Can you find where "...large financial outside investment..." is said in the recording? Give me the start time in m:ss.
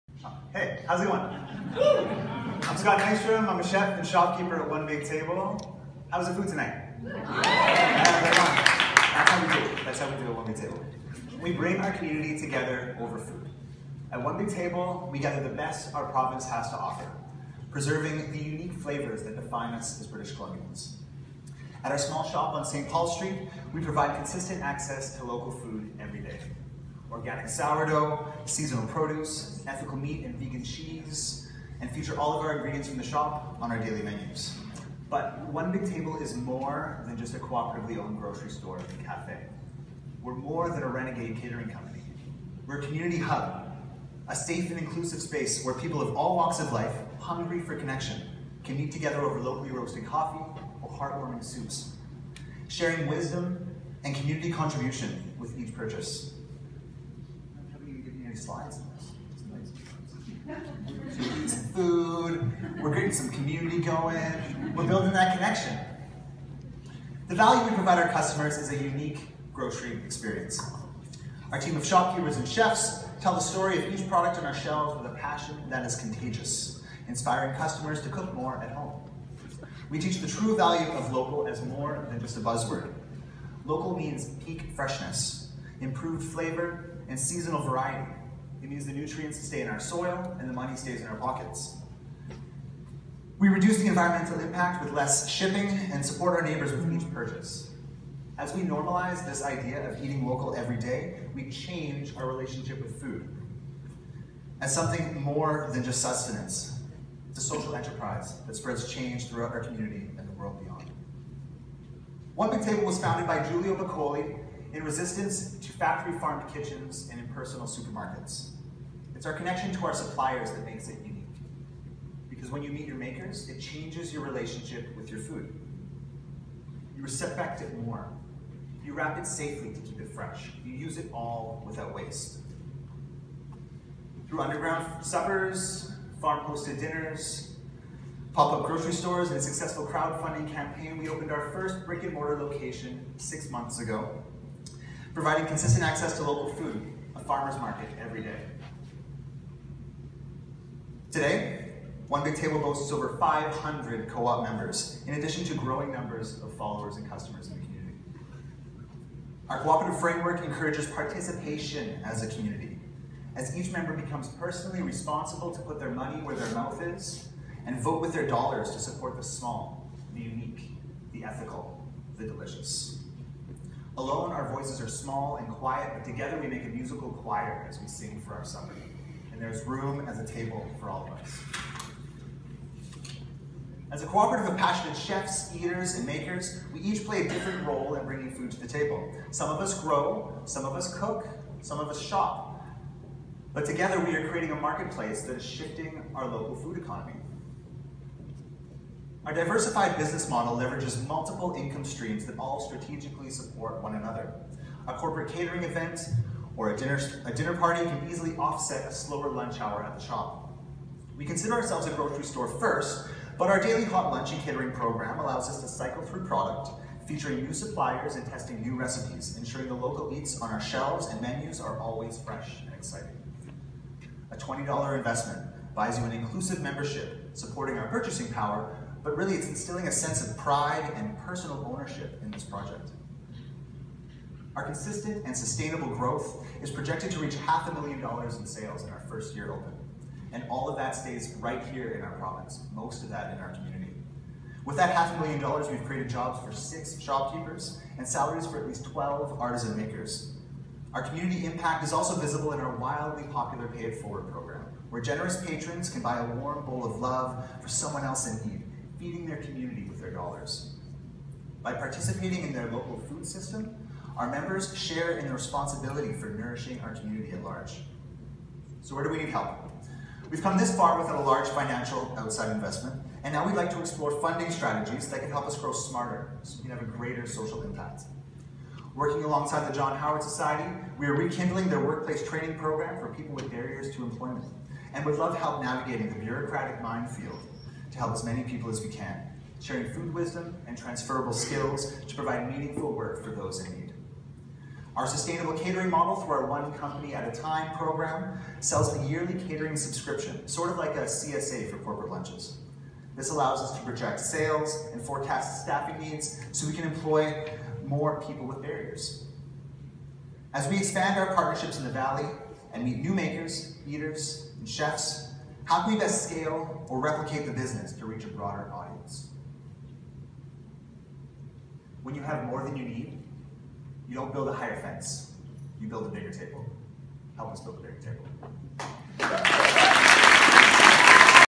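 4:31.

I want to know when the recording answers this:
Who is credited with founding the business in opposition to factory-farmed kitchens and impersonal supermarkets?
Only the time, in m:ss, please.
1:53.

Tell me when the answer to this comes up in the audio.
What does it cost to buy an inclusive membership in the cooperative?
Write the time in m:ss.
3:44.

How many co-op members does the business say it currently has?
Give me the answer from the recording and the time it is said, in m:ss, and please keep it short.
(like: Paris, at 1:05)
500, at 2:33.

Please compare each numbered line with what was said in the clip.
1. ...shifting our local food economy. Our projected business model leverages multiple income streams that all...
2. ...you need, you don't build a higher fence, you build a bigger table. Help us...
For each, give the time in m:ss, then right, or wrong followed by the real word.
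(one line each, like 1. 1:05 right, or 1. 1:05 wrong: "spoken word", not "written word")
1. 3:15 wrong: "diversified", not "projected"
2. 5:22 right.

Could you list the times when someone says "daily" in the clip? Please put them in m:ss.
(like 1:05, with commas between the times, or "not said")
0:33, 3:33.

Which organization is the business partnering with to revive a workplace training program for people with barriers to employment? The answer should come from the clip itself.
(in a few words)
John Howard Society.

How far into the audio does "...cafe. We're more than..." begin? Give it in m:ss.
0:39.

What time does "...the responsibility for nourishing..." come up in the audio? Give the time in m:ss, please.
4:25.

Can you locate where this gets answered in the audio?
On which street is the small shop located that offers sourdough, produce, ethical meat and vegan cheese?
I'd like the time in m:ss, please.
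0:22.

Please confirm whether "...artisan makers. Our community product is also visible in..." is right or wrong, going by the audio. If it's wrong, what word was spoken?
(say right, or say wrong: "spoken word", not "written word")
wrong: "impact", not "product".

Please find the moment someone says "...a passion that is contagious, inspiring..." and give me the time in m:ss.
1:15.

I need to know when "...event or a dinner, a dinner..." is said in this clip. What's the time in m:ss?
3:25.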